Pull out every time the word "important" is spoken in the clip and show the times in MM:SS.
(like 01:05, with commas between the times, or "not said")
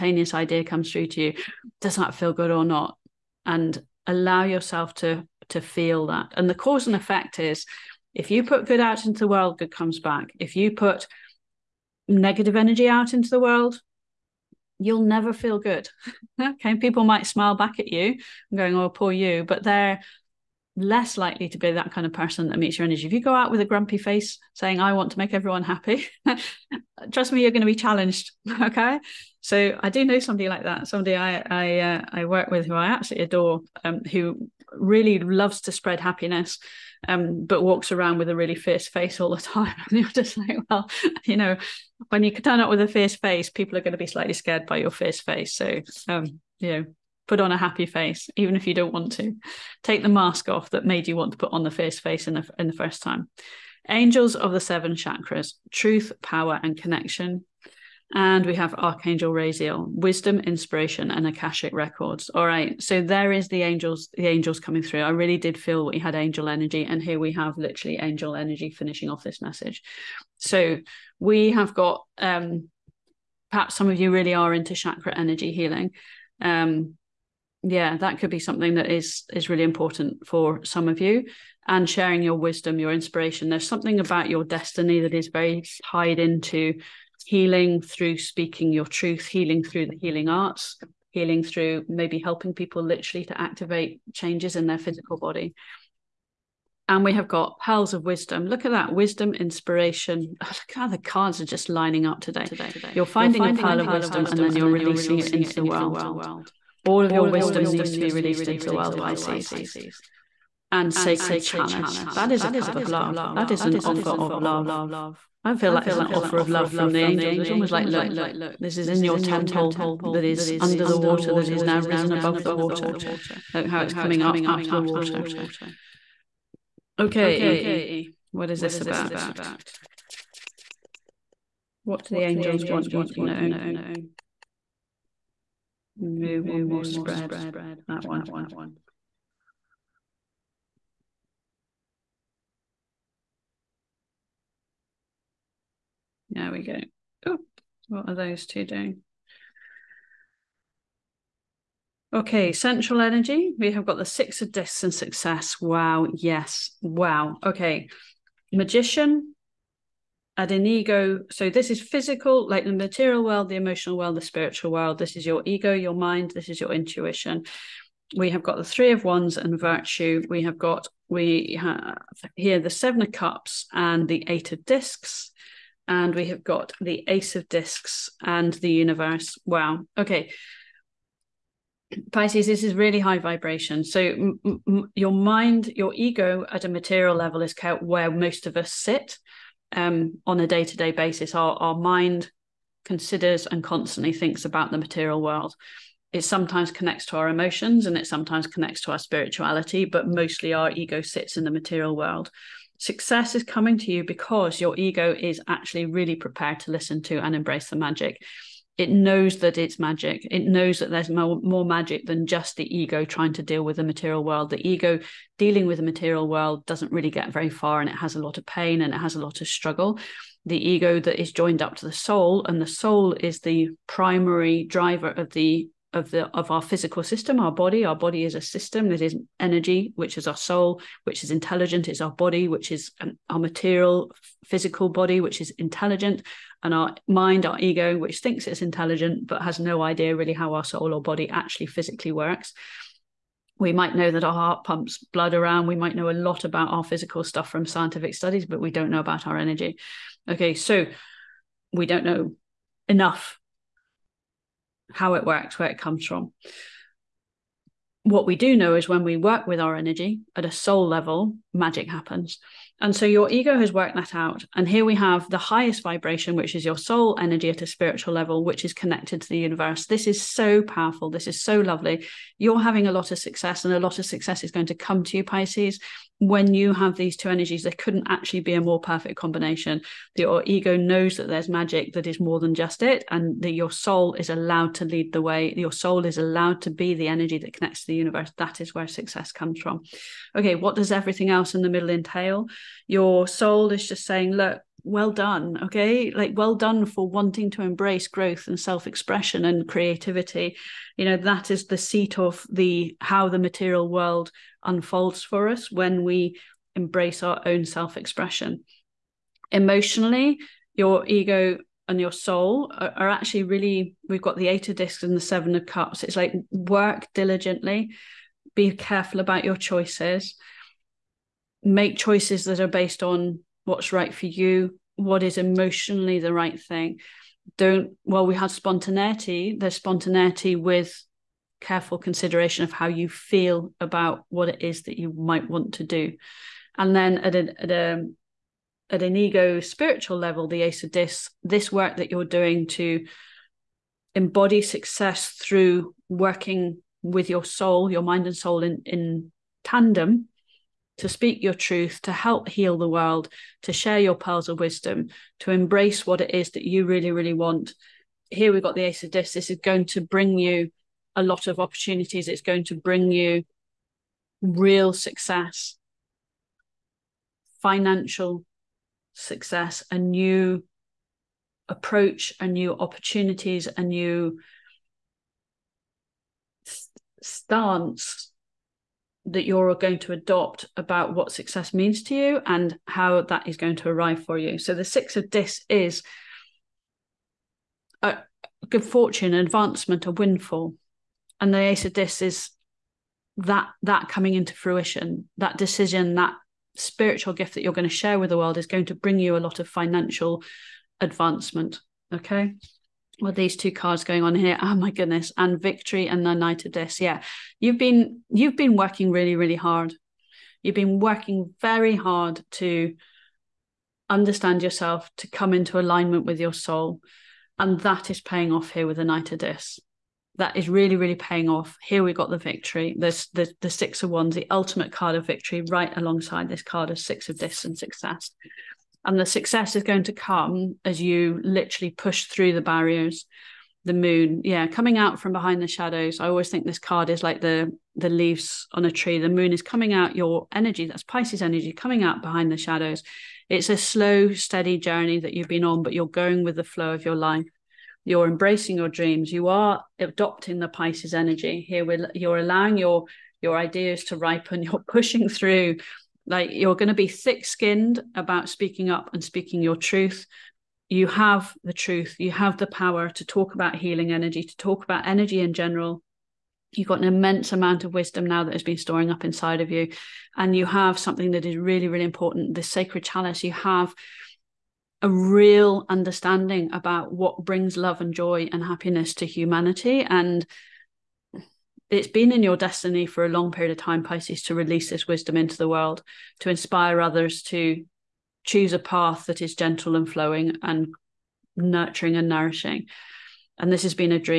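01:19, 07:52.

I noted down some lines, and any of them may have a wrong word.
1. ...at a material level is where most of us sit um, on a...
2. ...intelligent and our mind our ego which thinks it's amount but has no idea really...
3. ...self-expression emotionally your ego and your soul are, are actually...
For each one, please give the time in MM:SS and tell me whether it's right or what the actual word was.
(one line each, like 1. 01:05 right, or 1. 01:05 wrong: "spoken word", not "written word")
1. 03:06 right
2. 03:55 wrong: "intelligent", not "amount"
3. 05:07 right.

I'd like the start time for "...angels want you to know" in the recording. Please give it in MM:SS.
02:12.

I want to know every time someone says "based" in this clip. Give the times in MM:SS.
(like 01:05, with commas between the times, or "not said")
05:22.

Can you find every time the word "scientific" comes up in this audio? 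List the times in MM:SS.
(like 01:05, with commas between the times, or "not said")
04:07.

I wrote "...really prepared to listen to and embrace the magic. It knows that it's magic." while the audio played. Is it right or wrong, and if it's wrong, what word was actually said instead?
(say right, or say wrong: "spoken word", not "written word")
right.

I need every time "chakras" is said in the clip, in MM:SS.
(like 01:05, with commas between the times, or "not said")
00:54, 01:14.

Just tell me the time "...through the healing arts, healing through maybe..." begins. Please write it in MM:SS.
01:29.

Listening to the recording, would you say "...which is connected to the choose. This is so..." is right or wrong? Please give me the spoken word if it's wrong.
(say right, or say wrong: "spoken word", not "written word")
wrong: "universe", not "choose".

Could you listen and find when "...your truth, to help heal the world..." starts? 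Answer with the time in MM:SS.
05:51.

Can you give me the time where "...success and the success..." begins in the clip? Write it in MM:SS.
07:07.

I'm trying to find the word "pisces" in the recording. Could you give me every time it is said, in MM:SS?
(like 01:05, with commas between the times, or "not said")
01:48, 03:02, 04:35, 07:21, 07:30, 08:04.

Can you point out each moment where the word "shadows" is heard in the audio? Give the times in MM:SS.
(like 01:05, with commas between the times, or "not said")
07:15, 07:22.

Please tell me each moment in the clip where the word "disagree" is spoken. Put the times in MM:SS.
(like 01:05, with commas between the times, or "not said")
not said.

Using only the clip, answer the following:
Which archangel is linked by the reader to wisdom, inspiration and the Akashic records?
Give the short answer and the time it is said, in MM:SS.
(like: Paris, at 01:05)
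Archangel Raziel, at 00:58.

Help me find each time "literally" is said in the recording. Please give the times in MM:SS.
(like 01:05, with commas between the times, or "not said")
01:07, 01:32, 07:11.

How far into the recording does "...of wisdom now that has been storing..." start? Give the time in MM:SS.
07:47.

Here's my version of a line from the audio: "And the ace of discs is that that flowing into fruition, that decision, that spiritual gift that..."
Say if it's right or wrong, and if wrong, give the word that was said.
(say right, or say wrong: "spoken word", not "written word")
wrong: "coming", not "flowing".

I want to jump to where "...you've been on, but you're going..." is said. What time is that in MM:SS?
07:25.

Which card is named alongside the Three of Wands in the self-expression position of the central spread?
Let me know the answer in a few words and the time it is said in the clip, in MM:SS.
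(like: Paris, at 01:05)
Virtue, at 02:49.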